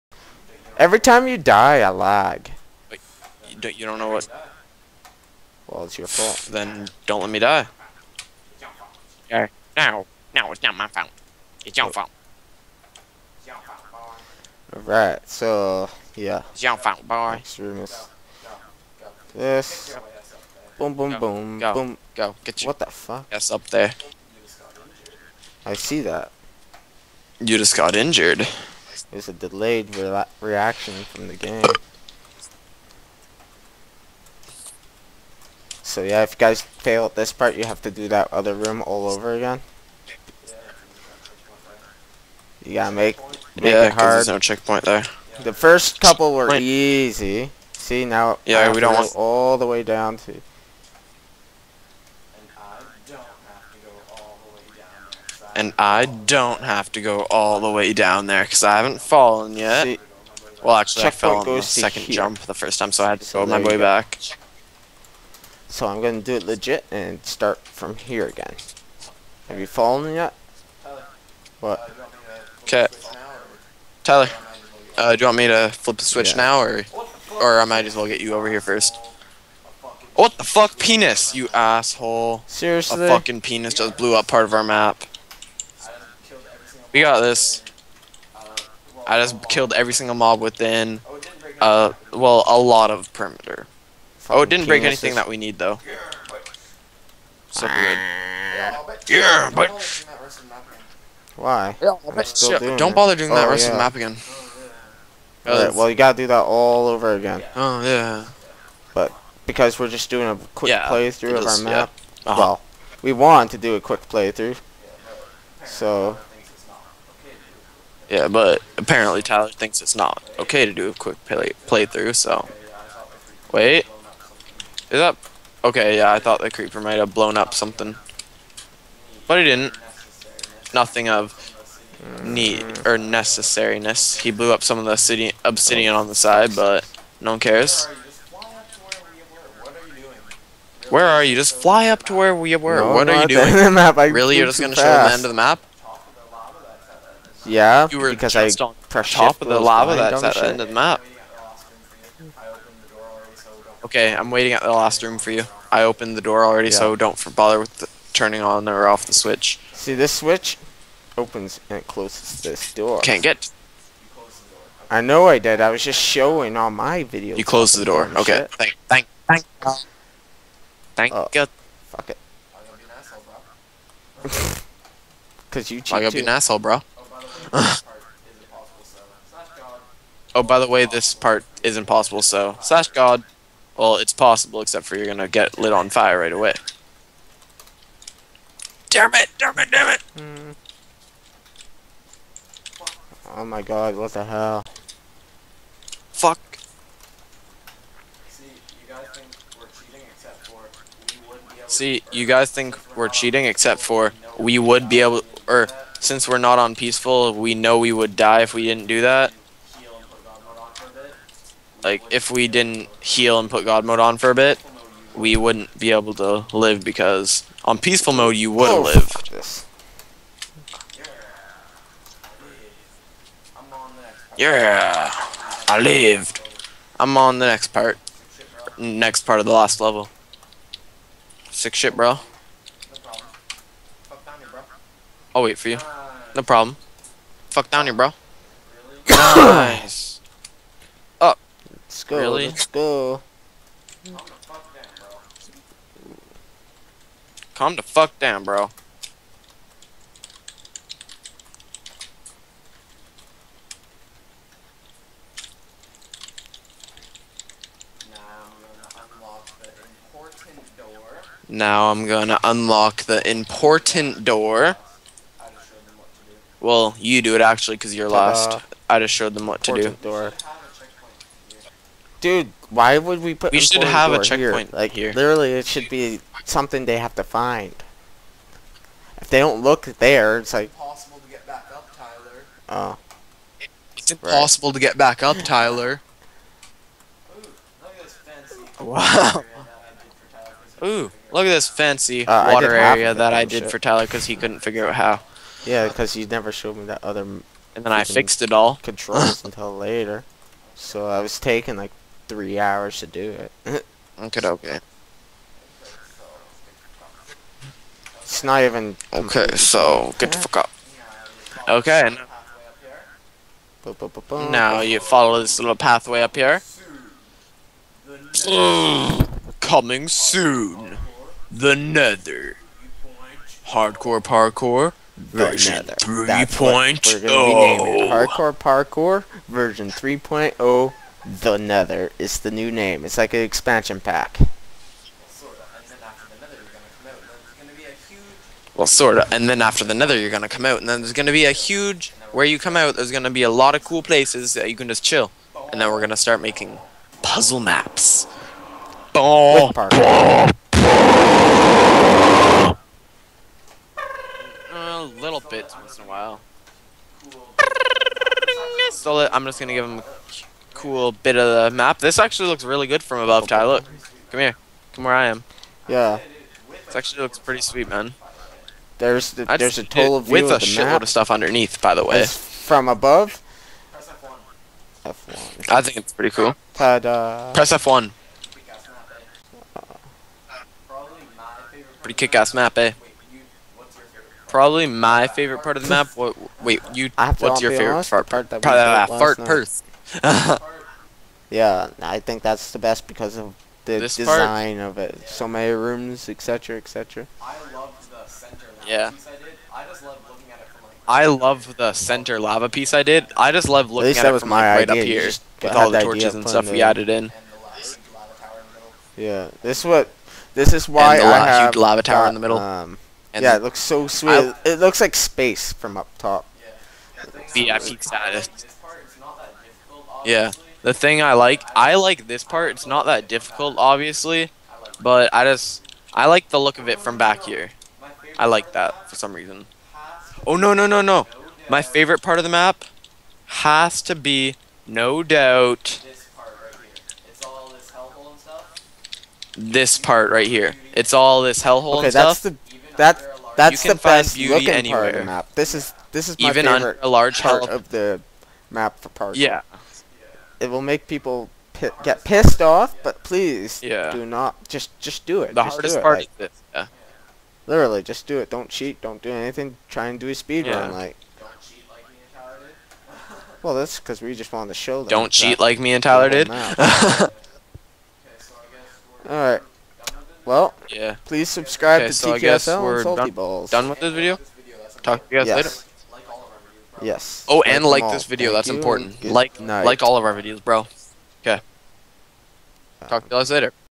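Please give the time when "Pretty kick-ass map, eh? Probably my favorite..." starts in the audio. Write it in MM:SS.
06:22.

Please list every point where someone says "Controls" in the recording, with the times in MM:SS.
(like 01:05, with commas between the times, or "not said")
04:58.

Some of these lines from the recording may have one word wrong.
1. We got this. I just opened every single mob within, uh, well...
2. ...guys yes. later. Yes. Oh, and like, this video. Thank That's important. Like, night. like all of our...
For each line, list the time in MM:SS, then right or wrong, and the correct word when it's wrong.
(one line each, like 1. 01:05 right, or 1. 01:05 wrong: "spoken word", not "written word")
1. 01:26 wrong: "killed", not "opened"
2. 07:55 right.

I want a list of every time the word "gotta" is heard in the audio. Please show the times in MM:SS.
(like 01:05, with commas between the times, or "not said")
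00:42, 01:45, 02:56.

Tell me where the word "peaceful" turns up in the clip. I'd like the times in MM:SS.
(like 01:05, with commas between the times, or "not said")
03:26, 03:37.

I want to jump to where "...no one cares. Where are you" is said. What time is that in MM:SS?
02:17.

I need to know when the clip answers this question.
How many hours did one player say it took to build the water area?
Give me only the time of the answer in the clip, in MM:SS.
05:02.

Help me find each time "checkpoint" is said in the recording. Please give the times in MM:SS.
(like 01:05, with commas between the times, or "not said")
00:44, 04:34.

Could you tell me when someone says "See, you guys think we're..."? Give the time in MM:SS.
03:21.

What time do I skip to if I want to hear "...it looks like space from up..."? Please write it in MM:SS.
06:54.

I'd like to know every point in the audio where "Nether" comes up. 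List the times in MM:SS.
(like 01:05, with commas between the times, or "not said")
05:21, 05:31, 05:39.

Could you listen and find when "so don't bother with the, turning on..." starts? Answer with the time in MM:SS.
02:36.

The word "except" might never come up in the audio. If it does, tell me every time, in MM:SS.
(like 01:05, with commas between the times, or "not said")
03:04, 03:23.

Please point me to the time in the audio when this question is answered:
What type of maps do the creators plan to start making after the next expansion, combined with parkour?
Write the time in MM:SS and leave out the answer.
05:47.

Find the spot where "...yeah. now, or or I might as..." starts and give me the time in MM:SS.
01:16.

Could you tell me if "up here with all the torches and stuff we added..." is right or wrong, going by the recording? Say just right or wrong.
right.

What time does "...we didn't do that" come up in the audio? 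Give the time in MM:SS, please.
03:28.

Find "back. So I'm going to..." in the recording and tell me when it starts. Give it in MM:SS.
01:03.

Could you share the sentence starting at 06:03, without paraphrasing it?
Look, come here, come where I am.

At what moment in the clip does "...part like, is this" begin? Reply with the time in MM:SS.
07:36.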